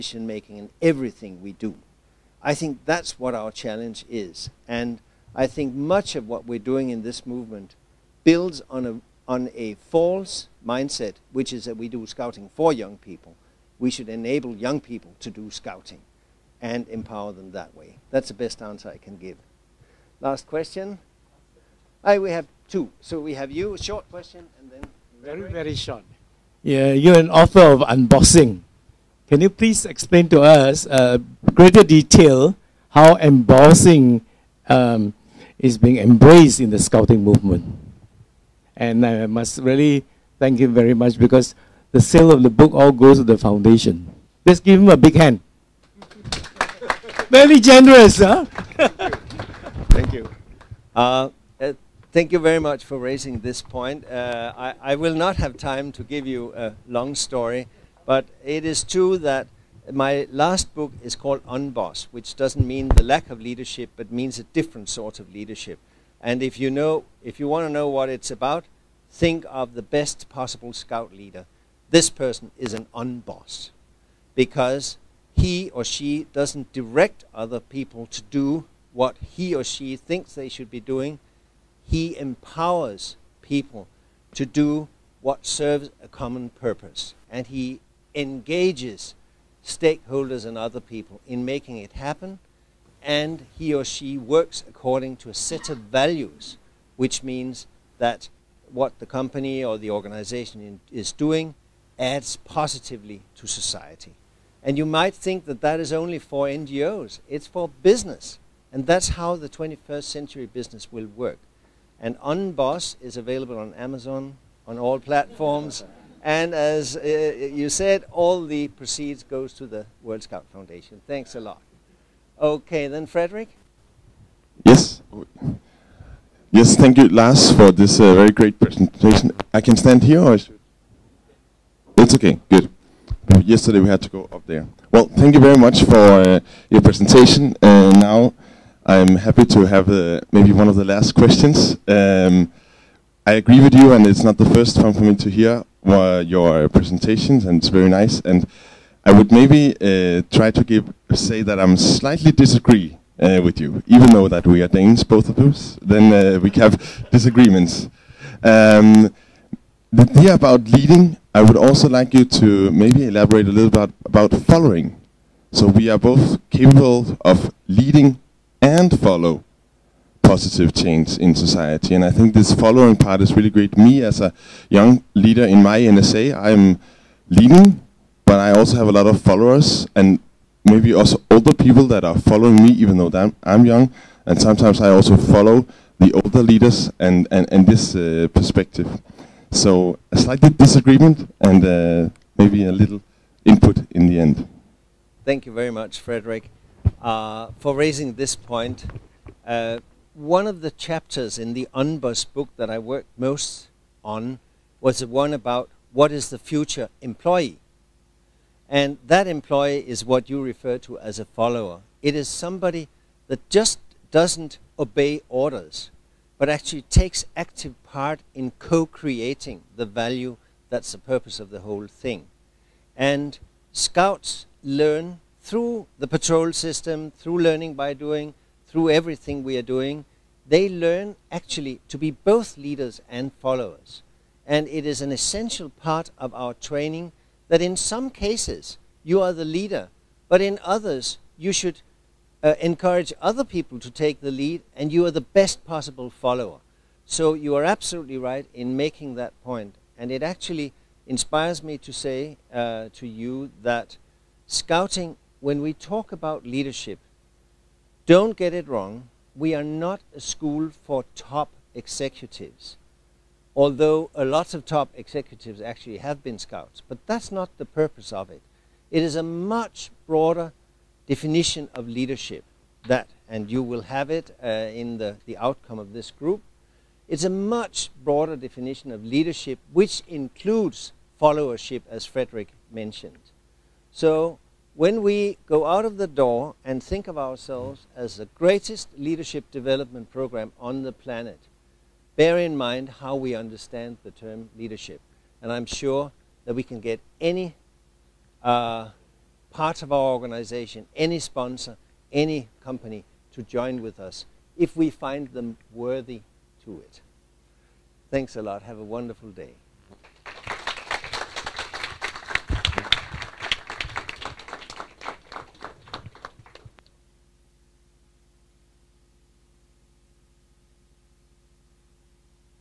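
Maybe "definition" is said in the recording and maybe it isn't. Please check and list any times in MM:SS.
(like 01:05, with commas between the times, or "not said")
04:31, 04:38.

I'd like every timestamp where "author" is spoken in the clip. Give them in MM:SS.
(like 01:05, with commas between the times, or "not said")
00:27.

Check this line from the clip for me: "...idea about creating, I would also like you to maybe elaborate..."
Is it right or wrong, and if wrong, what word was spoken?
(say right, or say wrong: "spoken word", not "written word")
wrong: "leading", not "creating".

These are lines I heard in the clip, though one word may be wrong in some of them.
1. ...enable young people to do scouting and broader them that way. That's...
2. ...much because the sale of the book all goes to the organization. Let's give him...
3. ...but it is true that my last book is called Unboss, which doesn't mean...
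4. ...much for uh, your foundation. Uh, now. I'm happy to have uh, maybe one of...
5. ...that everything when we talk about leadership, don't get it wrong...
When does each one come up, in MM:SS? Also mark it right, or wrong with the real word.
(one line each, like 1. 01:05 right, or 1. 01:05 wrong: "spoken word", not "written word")
1. 00:14 wrong: "empower", not "broader"
2. 00:40 wrong: "foundation", not "organization"
3. 00:58 right
4. 02:15 wrong: "presentation", not "foundation"
5. 04:13 wrong: "scouting", not "everything".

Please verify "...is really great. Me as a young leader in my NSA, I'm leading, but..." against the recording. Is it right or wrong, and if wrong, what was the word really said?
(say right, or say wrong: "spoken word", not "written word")
right.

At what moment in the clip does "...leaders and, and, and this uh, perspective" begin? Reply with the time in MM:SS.
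03:06.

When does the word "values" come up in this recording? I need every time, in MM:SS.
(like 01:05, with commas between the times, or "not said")
01:35, 03:39.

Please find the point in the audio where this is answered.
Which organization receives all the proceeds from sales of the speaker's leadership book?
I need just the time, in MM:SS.
02:00.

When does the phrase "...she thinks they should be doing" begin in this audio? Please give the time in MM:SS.
01:19.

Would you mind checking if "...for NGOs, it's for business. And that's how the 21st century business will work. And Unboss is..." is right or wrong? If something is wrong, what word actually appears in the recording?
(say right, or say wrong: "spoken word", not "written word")
right.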